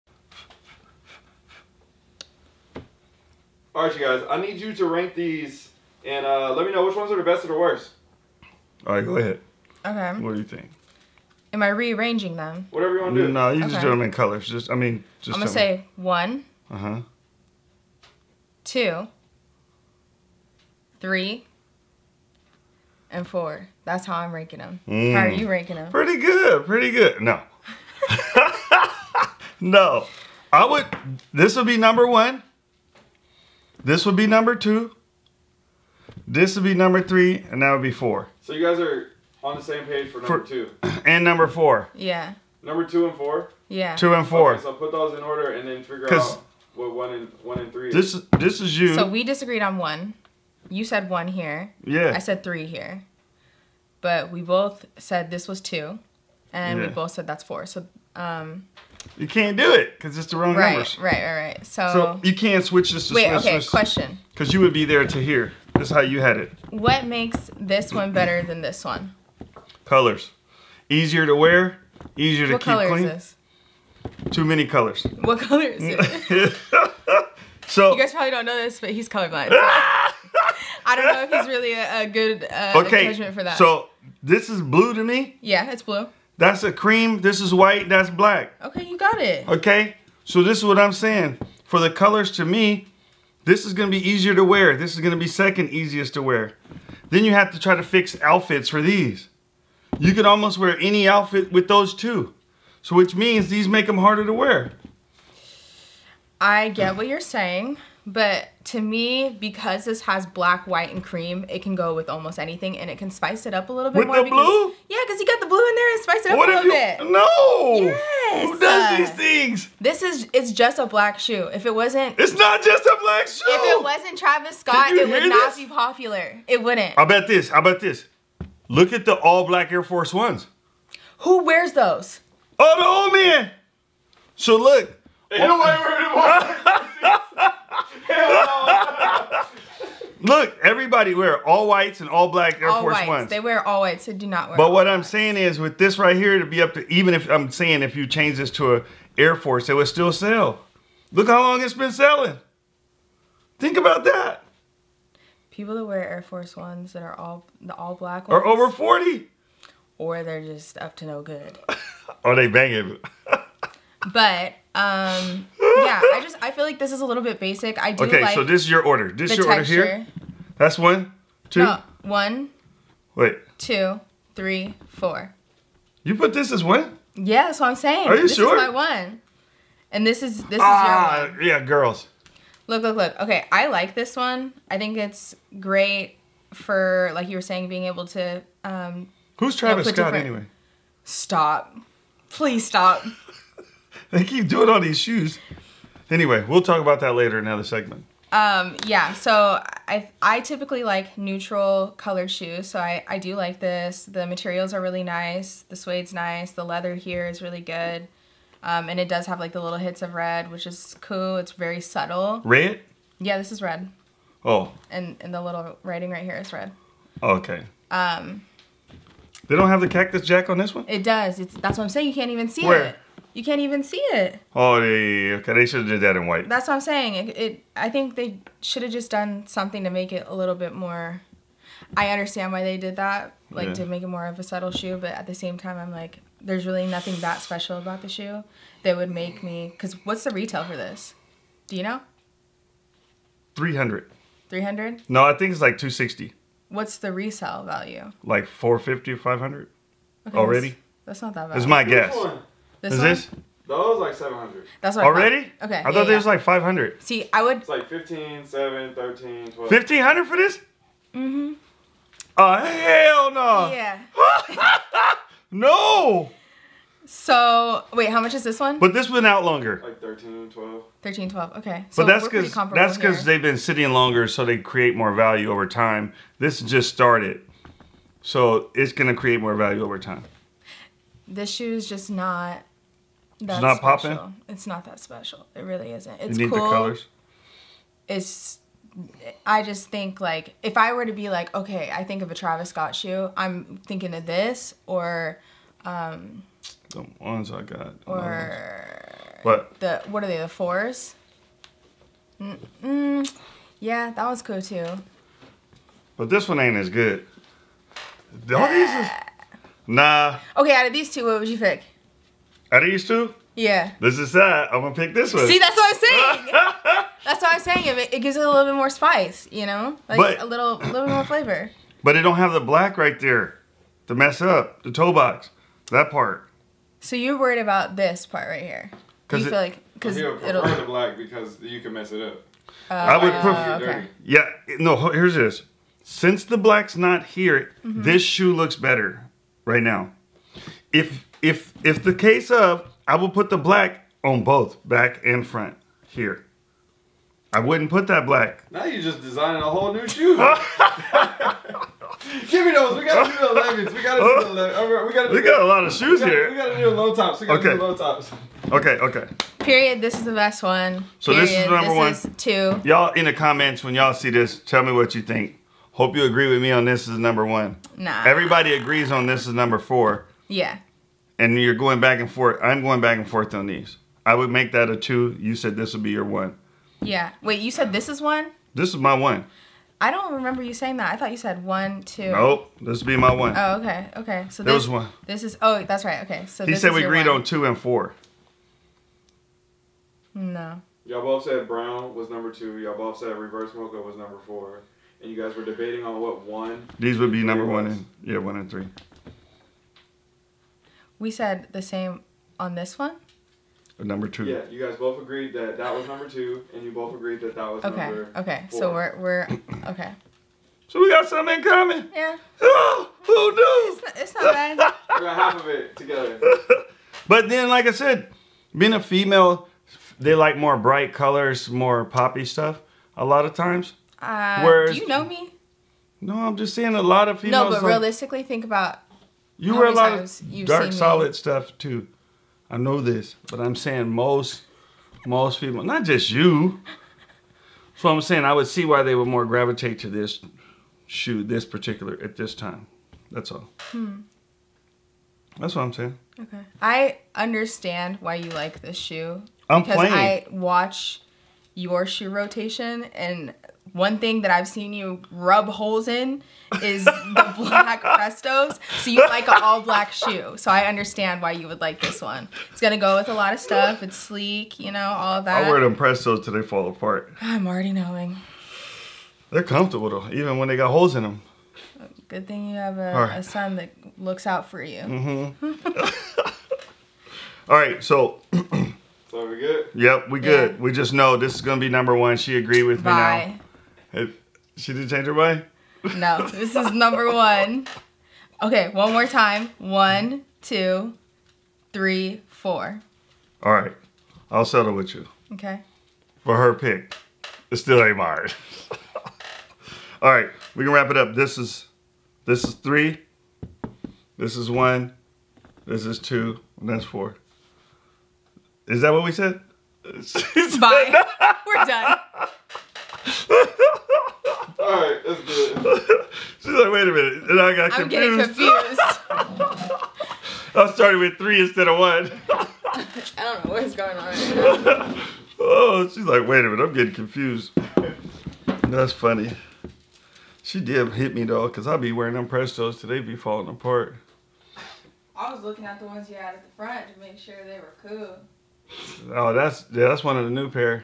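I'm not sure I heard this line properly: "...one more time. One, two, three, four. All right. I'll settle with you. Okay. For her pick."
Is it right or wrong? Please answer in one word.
right.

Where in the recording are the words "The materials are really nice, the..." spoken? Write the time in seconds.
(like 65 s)
204 s.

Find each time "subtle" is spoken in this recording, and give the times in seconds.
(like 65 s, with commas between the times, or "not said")
211 s, 234 s.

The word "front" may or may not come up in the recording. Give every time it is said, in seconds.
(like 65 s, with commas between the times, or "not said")
345 s, 536 s.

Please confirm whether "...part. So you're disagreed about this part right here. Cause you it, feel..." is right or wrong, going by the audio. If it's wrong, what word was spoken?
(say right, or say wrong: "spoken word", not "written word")
wrong: "worried", not "disagreed".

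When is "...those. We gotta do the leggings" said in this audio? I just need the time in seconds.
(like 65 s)
352 s.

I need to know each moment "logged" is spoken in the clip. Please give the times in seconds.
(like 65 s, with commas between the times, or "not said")
not said.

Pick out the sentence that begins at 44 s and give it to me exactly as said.
Okay, so put those in order and then figure out what one and one and three this, is.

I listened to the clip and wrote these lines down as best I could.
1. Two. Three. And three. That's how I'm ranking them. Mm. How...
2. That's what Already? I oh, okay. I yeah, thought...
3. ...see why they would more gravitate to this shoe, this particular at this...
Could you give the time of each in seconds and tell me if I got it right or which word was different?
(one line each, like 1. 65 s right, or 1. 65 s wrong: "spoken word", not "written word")
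1. 18 s wrong: "four", not "three"
2. 254 s right
3. 438 s right.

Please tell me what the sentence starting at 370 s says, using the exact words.
Yeah and you're going back and forth.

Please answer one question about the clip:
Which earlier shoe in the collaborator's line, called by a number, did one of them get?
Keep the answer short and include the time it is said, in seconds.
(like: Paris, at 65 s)
The fours, at 300 s.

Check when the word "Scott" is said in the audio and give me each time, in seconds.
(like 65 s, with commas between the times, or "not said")
124 s, 189 s, 292 s.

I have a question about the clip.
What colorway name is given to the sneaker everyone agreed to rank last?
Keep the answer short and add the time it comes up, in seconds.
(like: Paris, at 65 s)
Reverse mocha, at 393 s.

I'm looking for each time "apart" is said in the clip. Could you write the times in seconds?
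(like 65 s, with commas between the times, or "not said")
466 s, 533 s.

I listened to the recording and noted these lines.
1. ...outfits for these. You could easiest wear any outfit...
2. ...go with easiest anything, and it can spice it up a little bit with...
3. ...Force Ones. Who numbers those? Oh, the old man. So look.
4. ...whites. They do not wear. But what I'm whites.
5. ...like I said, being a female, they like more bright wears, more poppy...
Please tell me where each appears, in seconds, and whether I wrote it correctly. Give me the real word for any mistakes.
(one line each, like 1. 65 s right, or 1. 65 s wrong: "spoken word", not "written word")
1. 98 s wrong: "almost", not "easiest"
2. 111 s wrong: "almost", not "easiest"
3. 129 s wrong: "wears", not "numbers"
4. 143 s right
5. 417 s wrong: "colors", not "wears".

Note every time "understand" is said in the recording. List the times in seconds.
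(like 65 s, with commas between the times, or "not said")
232 s, 447 s, 460 s.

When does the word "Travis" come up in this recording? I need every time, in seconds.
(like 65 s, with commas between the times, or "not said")
124 s, 189 s, 292 s.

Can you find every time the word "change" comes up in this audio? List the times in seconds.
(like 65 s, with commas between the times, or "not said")
148 s, 485 s.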